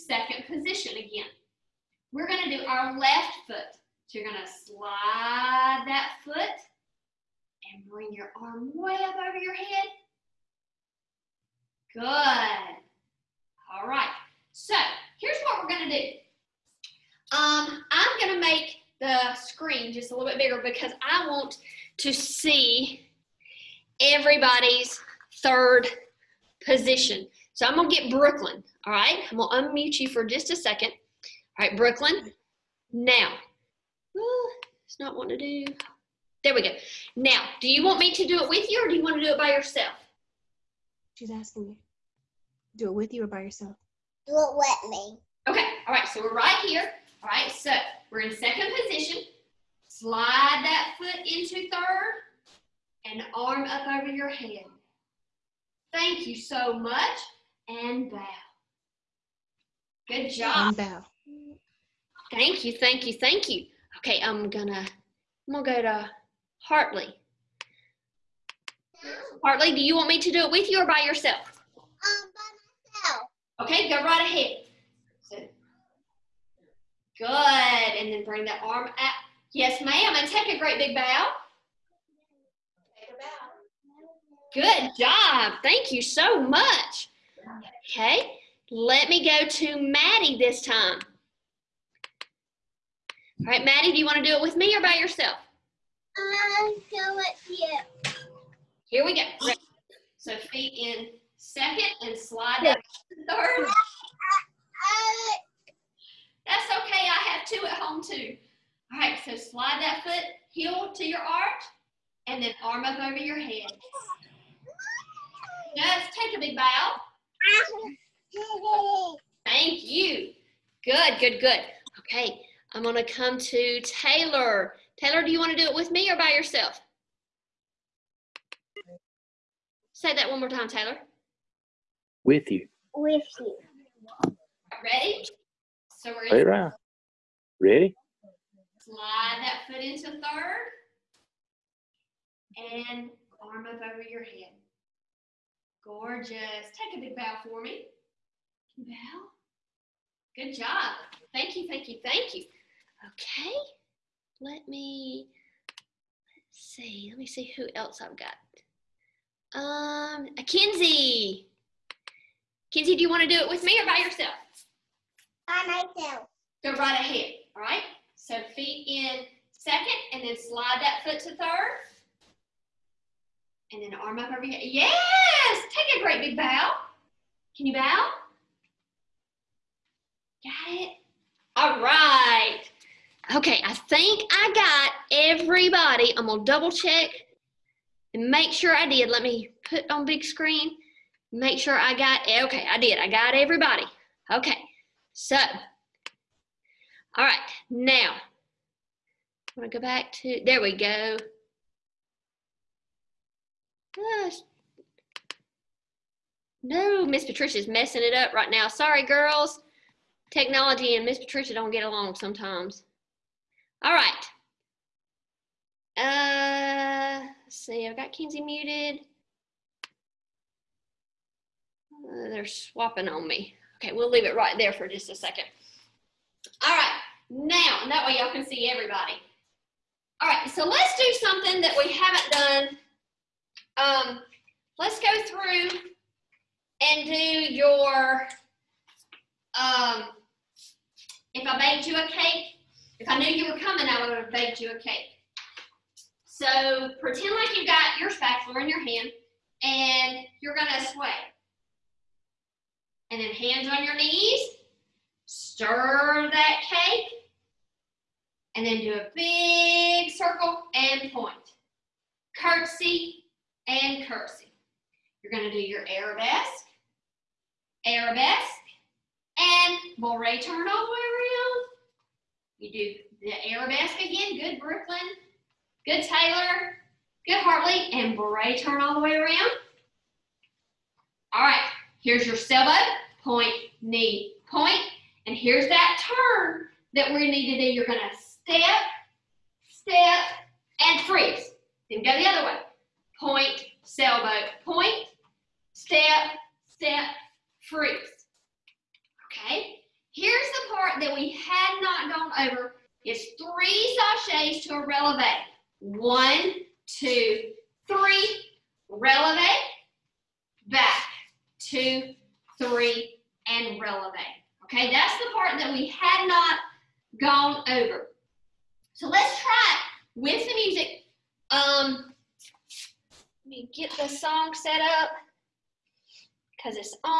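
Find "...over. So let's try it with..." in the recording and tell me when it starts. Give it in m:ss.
5:17.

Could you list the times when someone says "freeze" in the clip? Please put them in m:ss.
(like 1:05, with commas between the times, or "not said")
4:51, 4:57.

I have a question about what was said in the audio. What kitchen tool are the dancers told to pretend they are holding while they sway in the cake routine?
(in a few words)
spatula.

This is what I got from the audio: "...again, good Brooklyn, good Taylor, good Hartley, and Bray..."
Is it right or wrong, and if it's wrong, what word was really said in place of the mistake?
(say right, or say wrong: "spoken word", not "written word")
right.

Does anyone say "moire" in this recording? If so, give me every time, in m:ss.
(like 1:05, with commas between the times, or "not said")
4:29.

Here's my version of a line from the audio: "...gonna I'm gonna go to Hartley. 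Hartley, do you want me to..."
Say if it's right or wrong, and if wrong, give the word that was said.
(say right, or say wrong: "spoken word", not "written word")
right.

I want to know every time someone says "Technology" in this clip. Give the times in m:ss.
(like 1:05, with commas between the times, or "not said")
3:30.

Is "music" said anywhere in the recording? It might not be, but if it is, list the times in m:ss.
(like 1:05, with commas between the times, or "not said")
5:20.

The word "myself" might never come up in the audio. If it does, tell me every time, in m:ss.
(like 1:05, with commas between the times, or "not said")
1:12, 2:45.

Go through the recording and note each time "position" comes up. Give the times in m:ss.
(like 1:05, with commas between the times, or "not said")
0:00, 0:26, 0:48.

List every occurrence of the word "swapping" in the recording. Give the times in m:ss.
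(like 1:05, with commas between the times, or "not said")
3:42.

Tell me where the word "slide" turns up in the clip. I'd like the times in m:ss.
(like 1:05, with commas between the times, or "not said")
0:04, 0:49, 1:42, 1:49, 2:18, 2:50.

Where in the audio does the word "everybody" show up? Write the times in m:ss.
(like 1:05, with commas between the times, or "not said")
0:24, 3:05, 3:13, 3:48.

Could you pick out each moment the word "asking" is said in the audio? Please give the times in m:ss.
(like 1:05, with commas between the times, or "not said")
0:41.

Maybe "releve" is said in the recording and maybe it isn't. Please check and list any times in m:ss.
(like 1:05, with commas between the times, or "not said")
5:04, 5:08, 5:13.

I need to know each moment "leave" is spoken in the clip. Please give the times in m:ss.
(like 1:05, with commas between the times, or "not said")
3:44.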